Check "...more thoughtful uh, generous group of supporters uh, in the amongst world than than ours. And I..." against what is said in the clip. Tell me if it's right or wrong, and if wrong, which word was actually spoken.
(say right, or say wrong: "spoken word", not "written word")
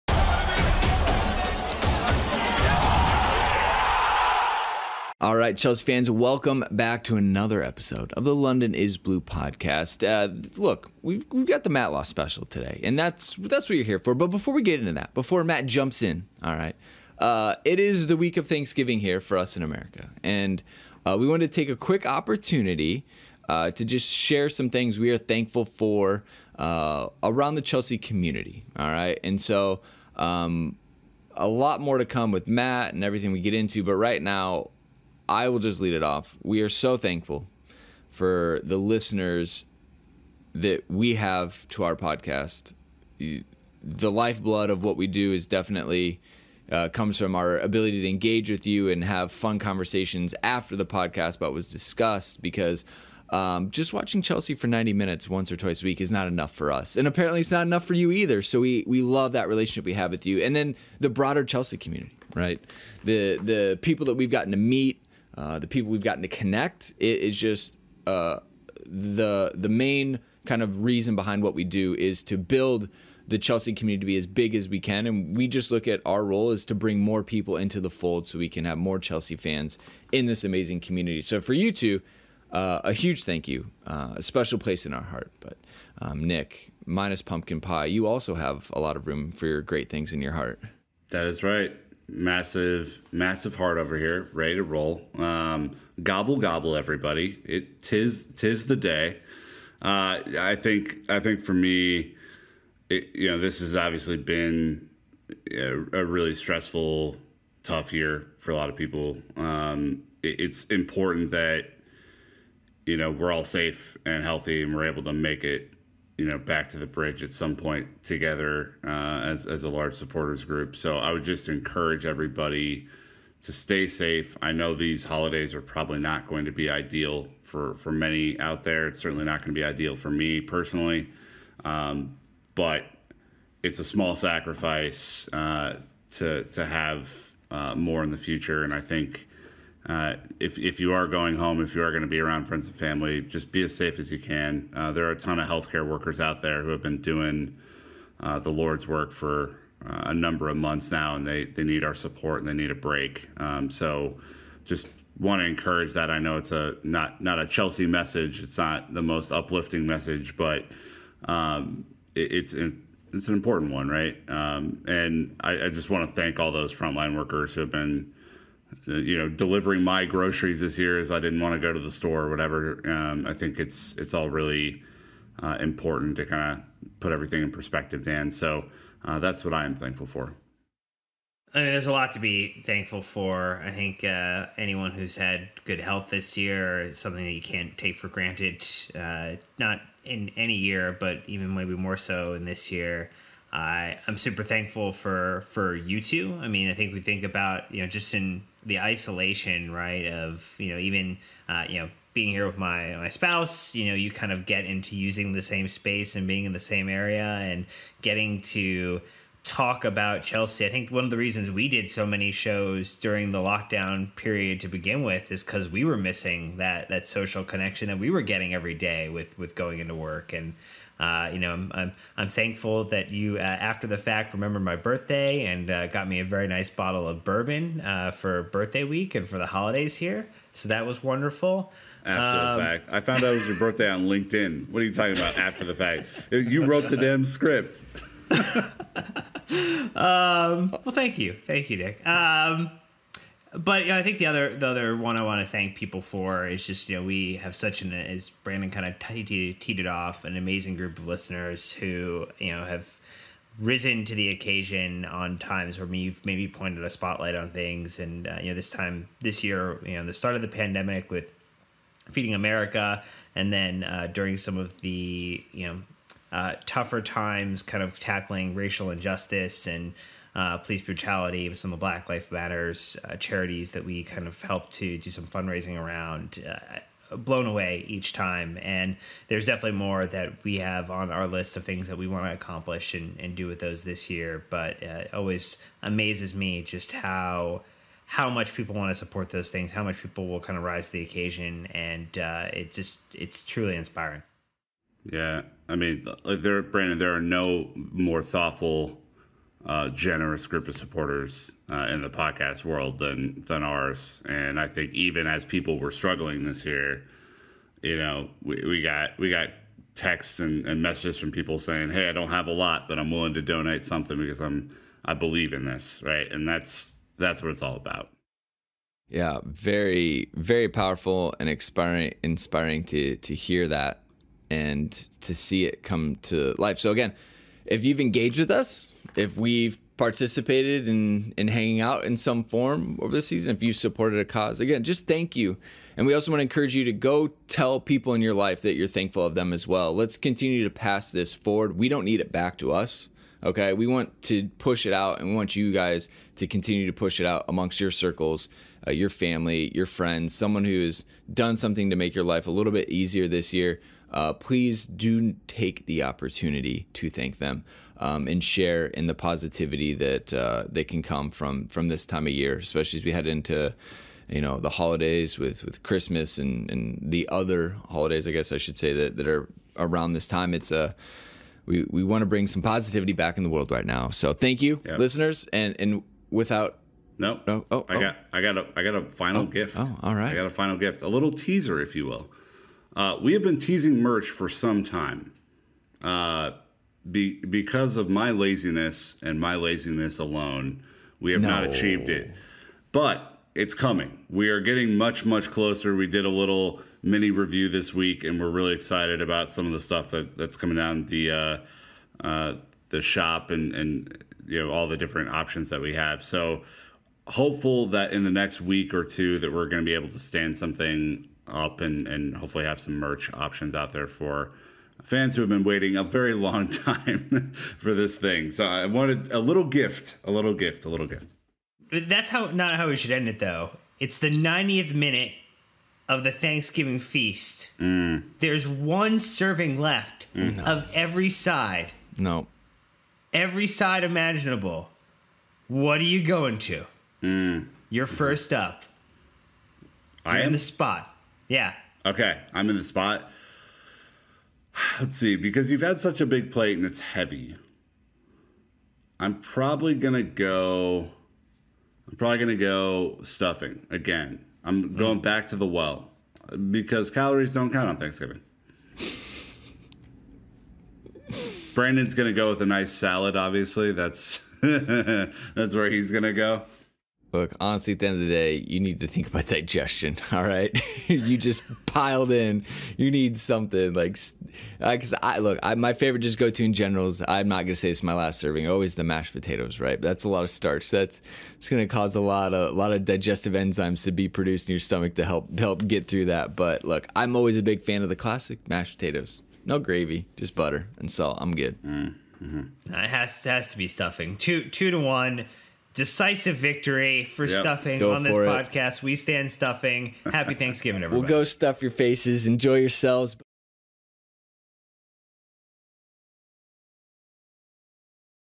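wrong: "podcast", not "amongst".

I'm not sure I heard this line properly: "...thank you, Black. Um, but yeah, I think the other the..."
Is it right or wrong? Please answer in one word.
wrong.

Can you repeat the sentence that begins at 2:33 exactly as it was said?
Um, so just want to encourage that.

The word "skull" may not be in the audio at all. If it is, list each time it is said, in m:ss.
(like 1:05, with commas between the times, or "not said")
not said.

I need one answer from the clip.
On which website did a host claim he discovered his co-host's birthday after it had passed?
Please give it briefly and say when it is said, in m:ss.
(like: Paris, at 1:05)
LinkedIn, at 3:54.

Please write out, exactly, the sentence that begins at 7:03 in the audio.
It's the 90th minute of the Thanksgiving feast.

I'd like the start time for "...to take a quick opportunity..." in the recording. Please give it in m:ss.
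0:21.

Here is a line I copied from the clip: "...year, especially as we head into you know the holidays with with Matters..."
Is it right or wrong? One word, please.
wrong.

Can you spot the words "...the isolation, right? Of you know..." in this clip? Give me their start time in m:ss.
3:18.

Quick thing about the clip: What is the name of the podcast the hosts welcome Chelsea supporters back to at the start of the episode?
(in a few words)
London Is Blue.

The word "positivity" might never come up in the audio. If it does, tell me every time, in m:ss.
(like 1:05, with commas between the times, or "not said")
5:59, 6:12.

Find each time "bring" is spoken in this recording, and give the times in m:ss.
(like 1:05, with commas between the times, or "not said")
1:16, 6:12.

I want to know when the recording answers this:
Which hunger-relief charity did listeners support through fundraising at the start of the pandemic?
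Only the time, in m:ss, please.
4:22.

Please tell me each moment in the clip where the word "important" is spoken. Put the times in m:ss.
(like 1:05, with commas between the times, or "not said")
1:50, 2:43, 2:55.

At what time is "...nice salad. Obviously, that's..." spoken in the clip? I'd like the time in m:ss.
7:42.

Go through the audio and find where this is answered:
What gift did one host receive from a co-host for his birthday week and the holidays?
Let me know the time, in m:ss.
3:47.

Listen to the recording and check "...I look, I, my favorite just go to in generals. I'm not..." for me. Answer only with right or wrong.
right.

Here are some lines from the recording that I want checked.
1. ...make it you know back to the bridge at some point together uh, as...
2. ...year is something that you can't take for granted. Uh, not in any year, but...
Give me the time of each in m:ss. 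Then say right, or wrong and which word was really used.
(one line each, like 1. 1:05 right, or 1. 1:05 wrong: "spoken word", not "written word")
1. 1:55 right
2. 3:06 right.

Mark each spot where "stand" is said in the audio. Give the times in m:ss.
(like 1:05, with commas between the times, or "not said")
6:50, 8:19.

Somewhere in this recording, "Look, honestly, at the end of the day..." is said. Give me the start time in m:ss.
7:47.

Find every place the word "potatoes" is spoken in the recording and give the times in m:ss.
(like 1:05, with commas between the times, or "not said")
7:59, 8:08.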